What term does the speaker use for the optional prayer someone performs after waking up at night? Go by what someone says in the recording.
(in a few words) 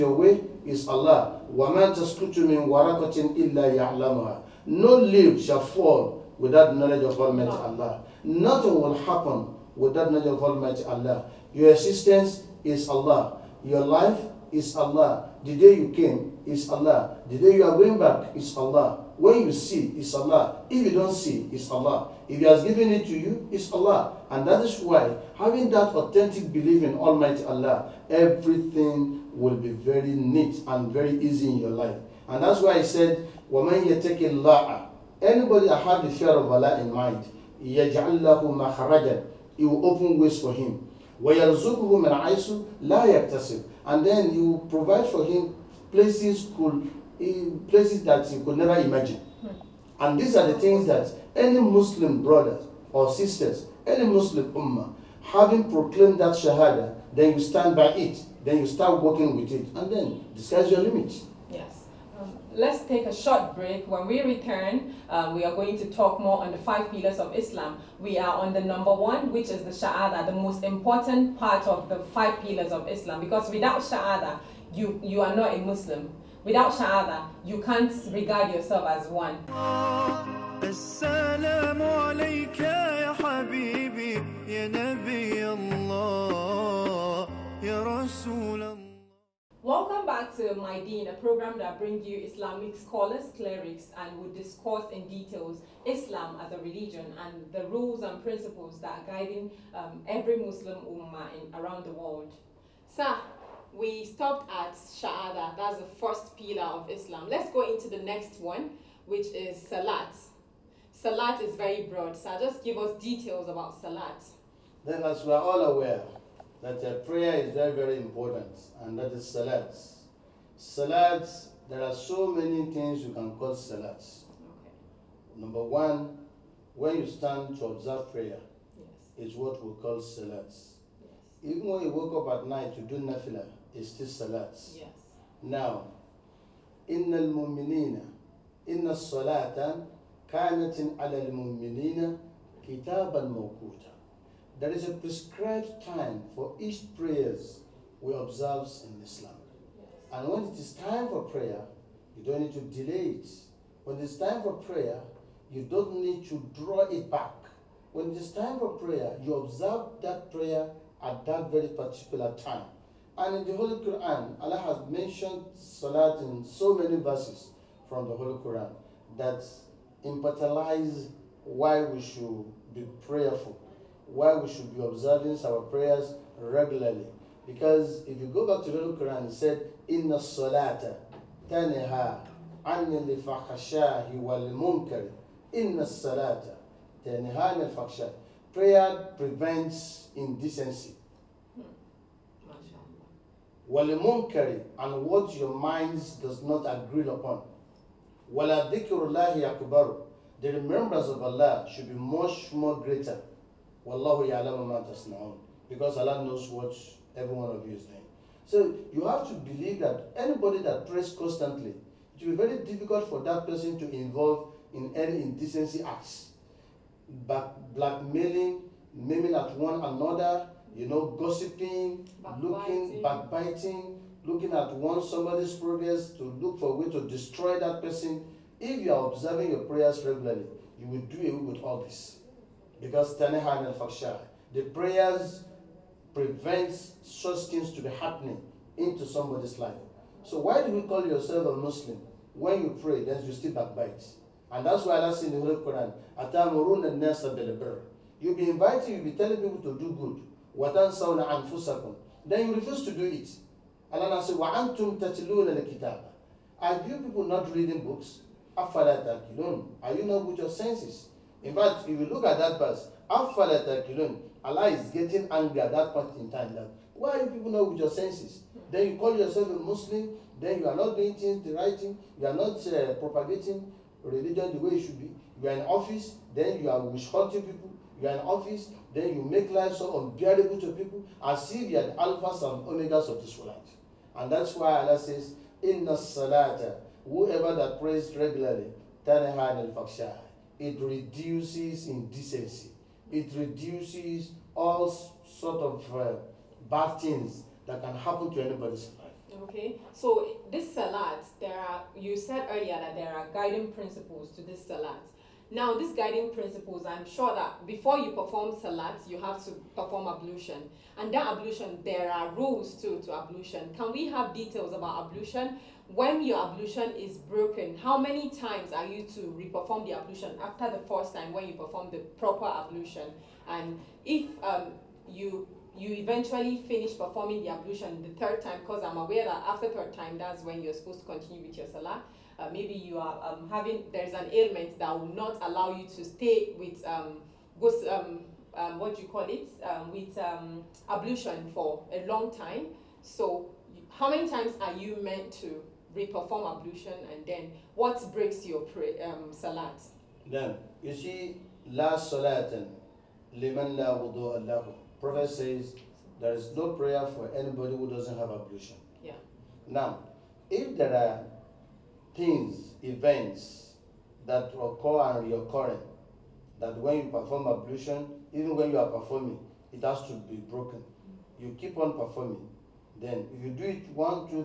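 nafila.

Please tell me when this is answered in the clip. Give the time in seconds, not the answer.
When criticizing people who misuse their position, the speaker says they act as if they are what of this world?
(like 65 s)
281 s.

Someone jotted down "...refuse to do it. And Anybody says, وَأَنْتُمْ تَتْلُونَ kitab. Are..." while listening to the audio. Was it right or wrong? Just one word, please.
wrong.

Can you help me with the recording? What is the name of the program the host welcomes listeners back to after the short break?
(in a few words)
My Deen.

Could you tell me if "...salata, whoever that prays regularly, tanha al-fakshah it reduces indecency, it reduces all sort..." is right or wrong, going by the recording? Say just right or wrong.
right.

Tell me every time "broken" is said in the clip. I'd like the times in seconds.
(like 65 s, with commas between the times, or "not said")
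317 s, 370 s.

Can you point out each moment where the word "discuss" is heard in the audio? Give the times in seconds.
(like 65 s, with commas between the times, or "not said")
60 s, 94 s.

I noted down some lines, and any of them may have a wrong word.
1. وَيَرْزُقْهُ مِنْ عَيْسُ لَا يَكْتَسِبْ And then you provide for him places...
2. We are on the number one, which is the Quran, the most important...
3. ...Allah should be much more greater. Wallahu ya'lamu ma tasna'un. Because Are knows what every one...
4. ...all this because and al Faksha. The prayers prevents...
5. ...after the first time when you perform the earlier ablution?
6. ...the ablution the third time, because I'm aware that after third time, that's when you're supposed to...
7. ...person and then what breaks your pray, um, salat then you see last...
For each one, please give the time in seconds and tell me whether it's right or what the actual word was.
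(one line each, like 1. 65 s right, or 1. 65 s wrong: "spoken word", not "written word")
1. 41 s right
2. 67 s wrong: "Shahada", not "Quran"
3. 201 s wrong: "Allah", not "Are"
4. 231 s right
5. 320 s wrong: "proper", not "earlier"
6. 327 s right
7. 346 s wrong: "ablution", not "person".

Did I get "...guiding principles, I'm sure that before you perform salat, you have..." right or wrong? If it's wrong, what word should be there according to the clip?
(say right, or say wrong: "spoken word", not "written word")
right.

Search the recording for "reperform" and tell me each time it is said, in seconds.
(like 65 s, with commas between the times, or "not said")
319 s, 345 s.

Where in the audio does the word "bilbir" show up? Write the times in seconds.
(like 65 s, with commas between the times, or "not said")
247 s.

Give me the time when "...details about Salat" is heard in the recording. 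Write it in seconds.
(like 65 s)
112 s.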